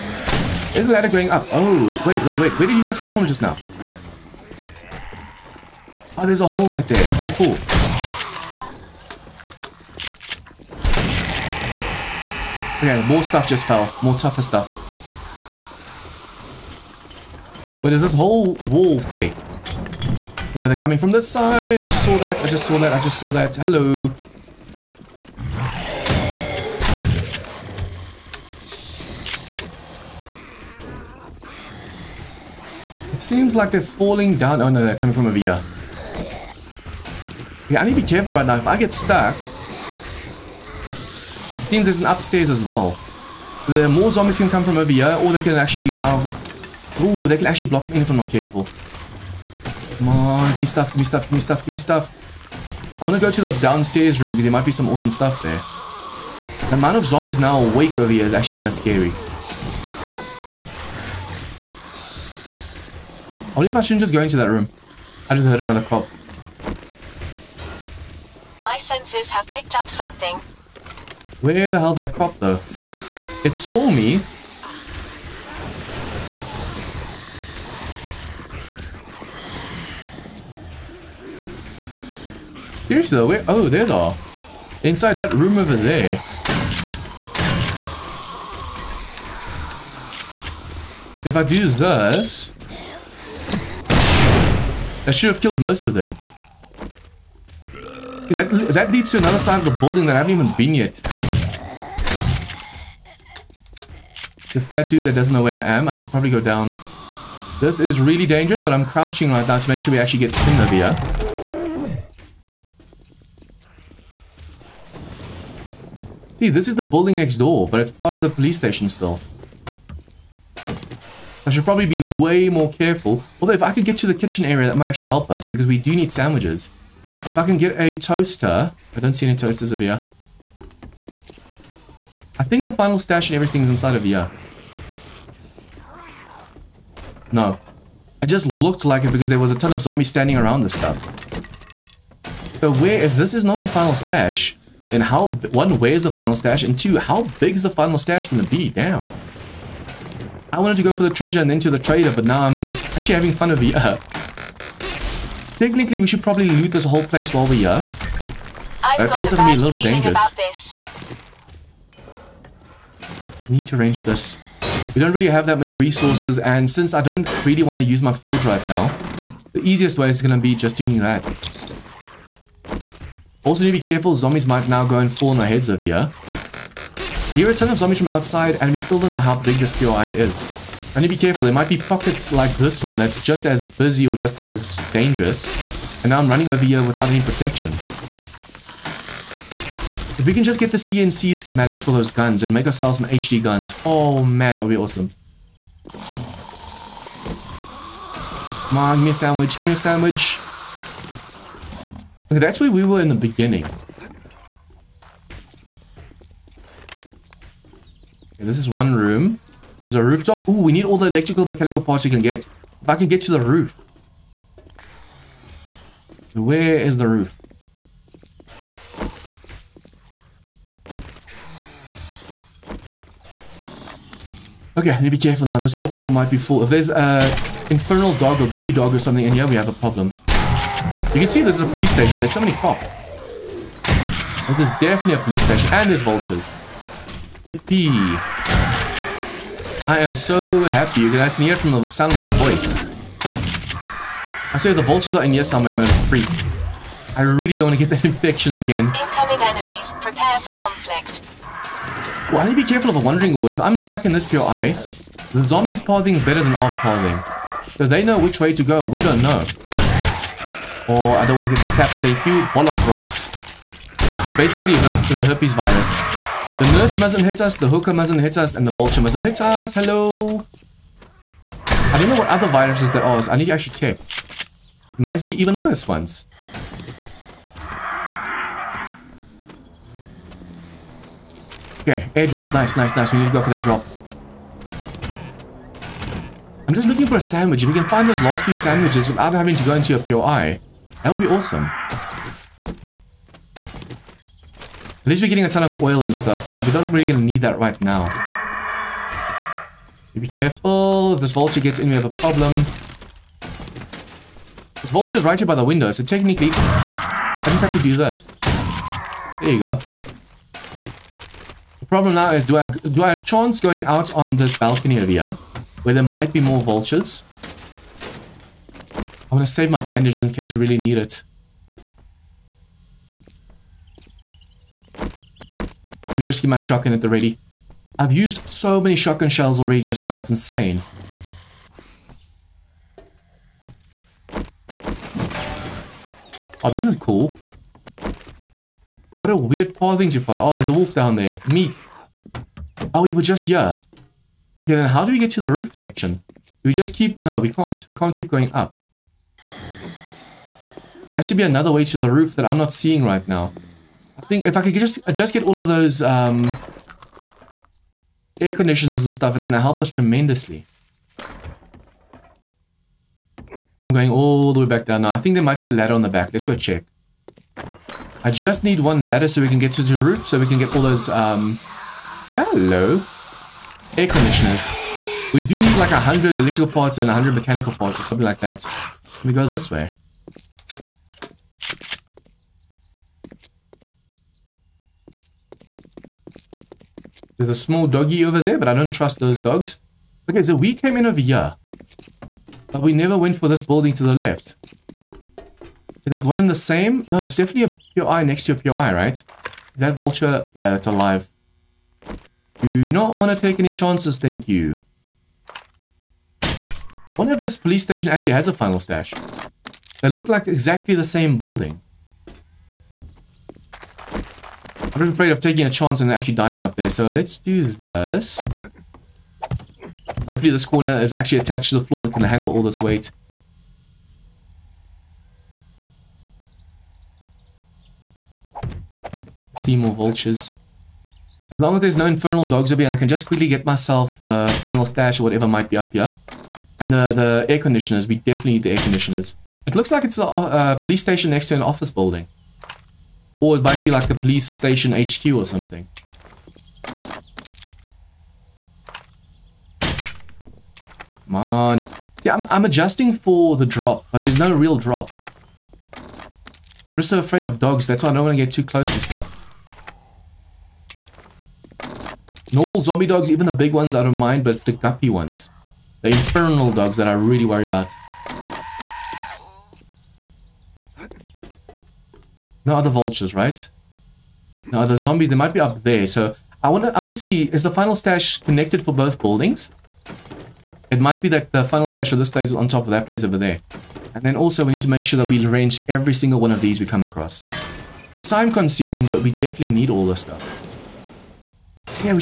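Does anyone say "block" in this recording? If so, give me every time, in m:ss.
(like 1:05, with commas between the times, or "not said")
0:47.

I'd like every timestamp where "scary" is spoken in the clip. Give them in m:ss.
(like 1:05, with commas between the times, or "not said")
0:58.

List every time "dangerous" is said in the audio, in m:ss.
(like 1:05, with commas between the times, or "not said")
1:48, 2:39, 3:04.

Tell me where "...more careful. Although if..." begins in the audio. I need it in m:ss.
2:02.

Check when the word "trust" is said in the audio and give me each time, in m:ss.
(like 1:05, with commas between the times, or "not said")
6:28.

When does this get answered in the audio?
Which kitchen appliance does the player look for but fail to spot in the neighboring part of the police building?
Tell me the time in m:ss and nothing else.
2:07.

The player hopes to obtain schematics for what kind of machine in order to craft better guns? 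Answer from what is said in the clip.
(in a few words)
CNC.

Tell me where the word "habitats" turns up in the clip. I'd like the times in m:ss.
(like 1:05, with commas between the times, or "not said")
not said.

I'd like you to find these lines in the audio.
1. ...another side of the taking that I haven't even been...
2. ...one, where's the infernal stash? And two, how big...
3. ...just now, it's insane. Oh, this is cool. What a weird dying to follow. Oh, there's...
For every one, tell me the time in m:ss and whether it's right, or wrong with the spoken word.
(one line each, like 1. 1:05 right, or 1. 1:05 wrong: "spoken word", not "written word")
1. 1:39 wrong: "building", not "taking"
2. 2:25 wrong: "final", not "infernal"
3. 5:29 wrong: "pathing", not "dying".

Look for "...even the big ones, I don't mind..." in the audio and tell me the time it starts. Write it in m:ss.
7:43.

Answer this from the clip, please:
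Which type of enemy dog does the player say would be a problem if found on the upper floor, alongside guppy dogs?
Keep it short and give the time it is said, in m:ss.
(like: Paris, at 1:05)
Infernal dog, at 3:47.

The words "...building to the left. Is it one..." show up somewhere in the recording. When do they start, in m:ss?
6:33.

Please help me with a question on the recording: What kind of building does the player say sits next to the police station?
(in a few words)
Office building.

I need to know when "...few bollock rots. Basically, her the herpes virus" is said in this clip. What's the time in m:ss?
4:22.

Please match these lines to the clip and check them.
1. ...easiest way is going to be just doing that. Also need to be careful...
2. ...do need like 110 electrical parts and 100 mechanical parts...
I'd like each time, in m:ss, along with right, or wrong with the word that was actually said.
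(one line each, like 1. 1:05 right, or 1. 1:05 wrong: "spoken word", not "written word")
1. 2:49 right
2. 6:15 wrong: "100", not "110".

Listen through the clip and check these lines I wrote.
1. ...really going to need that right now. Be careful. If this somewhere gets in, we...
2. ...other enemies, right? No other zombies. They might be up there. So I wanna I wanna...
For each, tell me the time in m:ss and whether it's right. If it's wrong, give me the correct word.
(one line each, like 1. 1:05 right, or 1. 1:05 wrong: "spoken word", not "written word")
1. 4:56 wrong: "vulture", not "somewhere"
2. 7:52 wrong: "vultures", not "enemies".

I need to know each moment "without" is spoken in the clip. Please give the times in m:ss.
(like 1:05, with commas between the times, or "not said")
3:06, 4:49.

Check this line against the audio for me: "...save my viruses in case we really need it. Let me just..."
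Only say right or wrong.
wrong.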